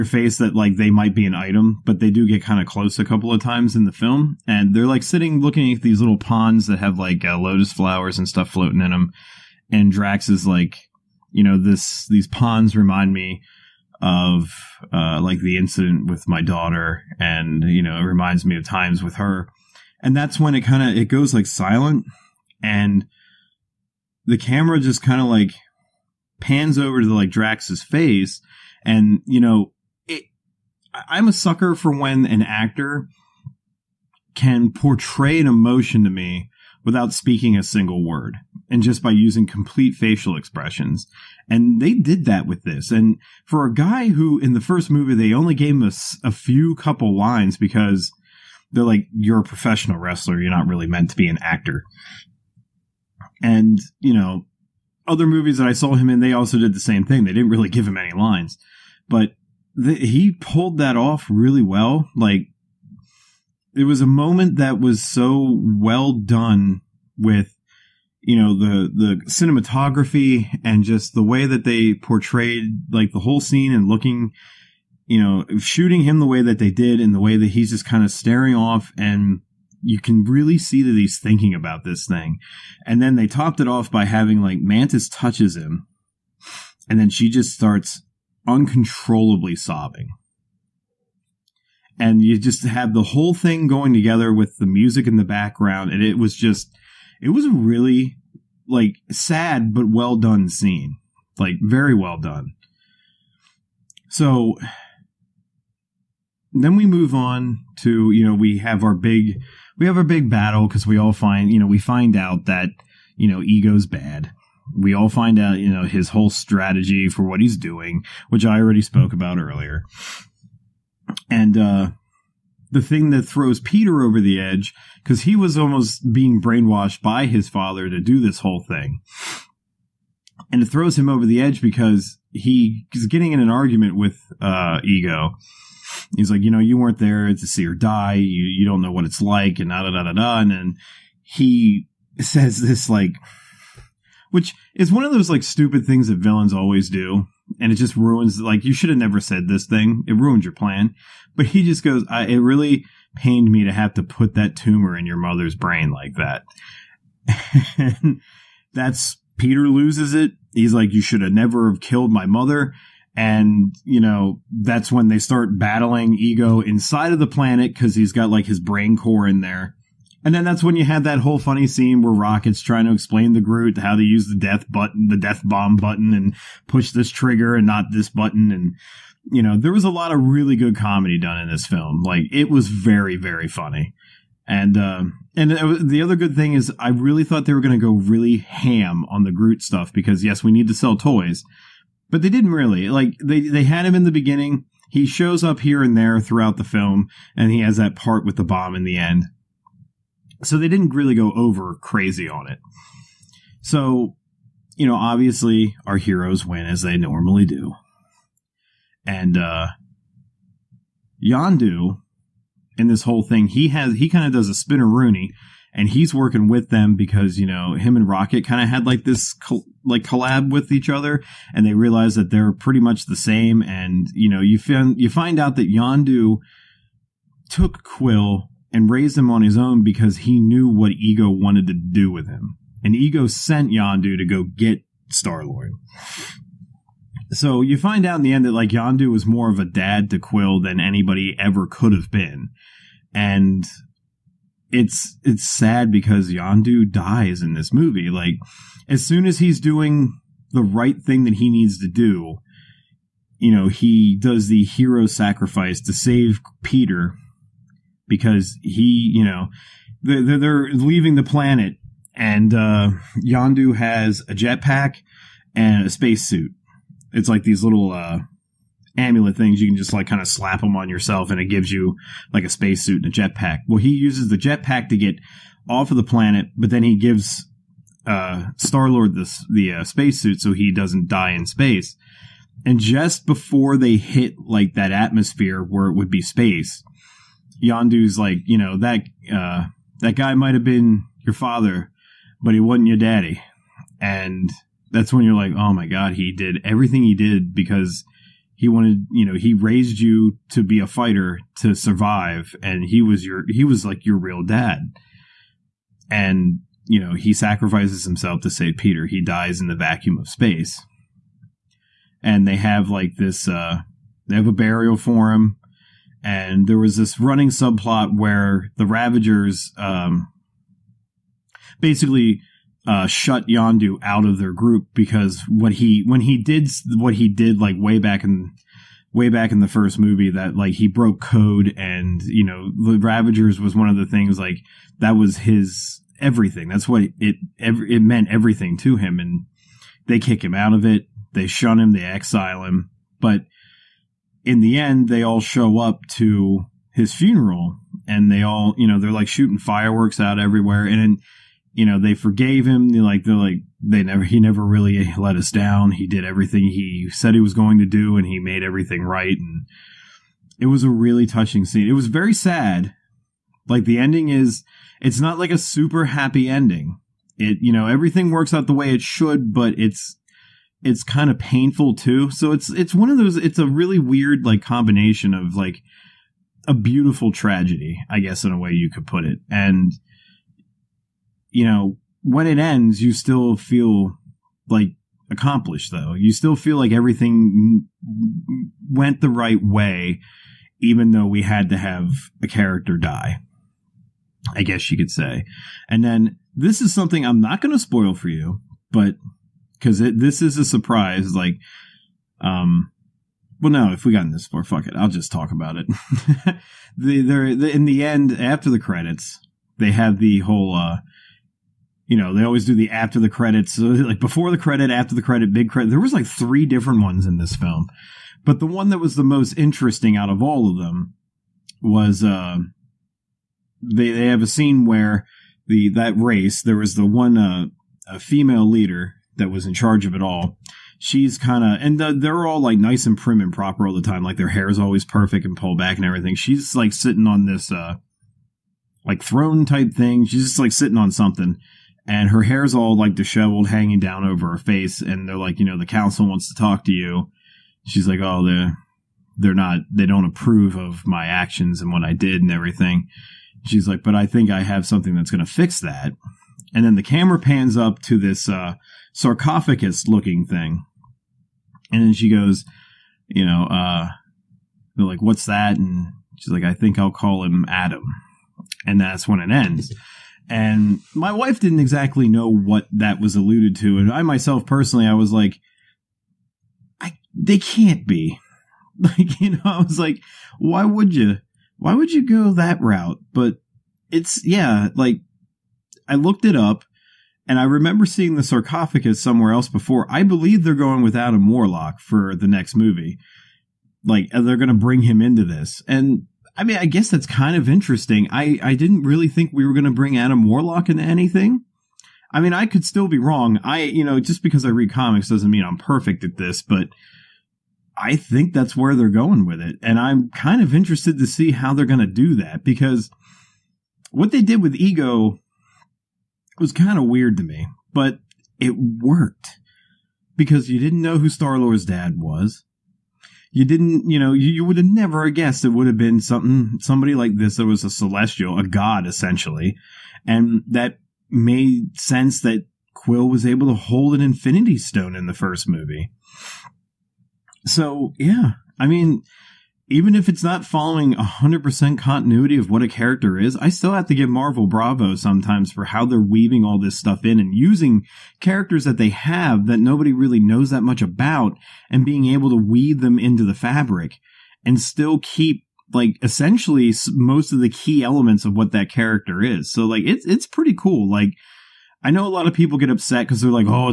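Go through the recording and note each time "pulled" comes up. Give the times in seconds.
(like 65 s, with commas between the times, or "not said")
60 s, 435 s.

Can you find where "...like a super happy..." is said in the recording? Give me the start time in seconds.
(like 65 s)
365 s.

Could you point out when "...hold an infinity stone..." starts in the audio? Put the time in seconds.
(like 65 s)
533 s.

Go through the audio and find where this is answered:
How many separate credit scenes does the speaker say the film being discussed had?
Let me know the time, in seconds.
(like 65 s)
416 s.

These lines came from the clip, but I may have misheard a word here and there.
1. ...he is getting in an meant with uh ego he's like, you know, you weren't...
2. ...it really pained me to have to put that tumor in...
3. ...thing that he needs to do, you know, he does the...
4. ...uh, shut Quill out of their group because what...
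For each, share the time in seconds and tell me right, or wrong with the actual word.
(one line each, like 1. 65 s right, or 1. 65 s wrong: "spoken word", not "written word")
1. 132 s wrong: "argument", not "meant"
2. 152 s right
3. 251 s right
4. 322 s wrong: "Yondu", not "Quill".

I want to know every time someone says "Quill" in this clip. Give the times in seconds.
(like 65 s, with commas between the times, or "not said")
227 s, 240 s, 532 s.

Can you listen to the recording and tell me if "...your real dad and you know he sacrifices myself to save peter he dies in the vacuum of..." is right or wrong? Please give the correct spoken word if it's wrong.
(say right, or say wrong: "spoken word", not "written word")
wrong: "himself", not "myself".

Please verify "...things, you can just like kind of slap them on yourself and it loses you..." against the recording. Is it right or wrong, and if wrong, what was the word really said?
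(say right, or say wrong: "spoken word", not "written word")
wrong: "gives", not "loses".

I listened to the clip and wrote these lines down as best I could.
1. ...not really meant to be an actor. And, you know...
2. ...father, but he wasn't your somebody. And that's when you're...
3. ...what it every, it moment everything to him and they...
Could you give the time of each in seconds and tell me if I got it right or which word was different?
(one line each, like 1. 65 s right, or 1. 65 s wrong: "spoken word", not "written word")
1. 50 s right
2. 291 s wrong: "daddy", not "somebody"
3. 336 s wrong: "meant", not "moment".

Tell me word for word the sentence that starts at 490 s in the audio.
I believe they're going with Adam Warlock for the next movie.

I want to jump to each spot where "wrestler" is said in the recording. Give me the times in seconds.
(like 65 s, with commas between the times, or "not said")
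49 s.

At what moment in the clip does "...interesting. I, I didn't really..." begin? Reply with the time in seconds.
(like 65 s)
497 s.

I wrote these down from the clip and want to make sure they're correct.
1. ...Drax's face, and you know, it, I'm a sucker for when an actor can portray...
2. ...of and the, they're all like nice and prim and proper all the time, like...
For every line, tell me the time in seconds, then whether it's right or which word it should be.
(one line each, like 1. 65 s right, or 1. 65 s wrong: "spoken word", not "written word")
1. 27 s right
2. 431 s right.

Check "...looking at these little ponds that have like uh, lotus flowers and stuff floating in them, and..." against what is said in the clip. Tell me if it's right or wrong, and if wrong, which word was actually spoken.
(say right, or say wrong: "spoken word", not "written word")
right.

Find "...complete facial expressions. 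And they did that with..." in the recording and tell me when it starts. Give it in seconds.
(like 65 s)
39 s.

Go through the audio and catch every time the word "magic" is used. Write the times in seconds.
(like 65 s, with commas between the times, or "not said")
not said.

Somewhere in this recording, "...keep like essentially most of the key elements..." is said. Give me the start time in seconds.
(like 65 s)
555 s.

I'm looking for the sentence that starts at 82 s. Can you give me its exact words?
And then they topped it off by having like Mantis touches him, and then she just starts uncontrollably sobbing.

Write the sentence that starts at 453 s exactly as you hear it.
She's like, but I think I have something that's going to fix that.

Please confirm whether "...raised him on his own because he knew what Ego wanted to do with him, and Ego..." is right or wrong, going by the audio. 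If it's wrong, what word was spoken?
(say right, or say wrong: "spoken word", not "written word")
right.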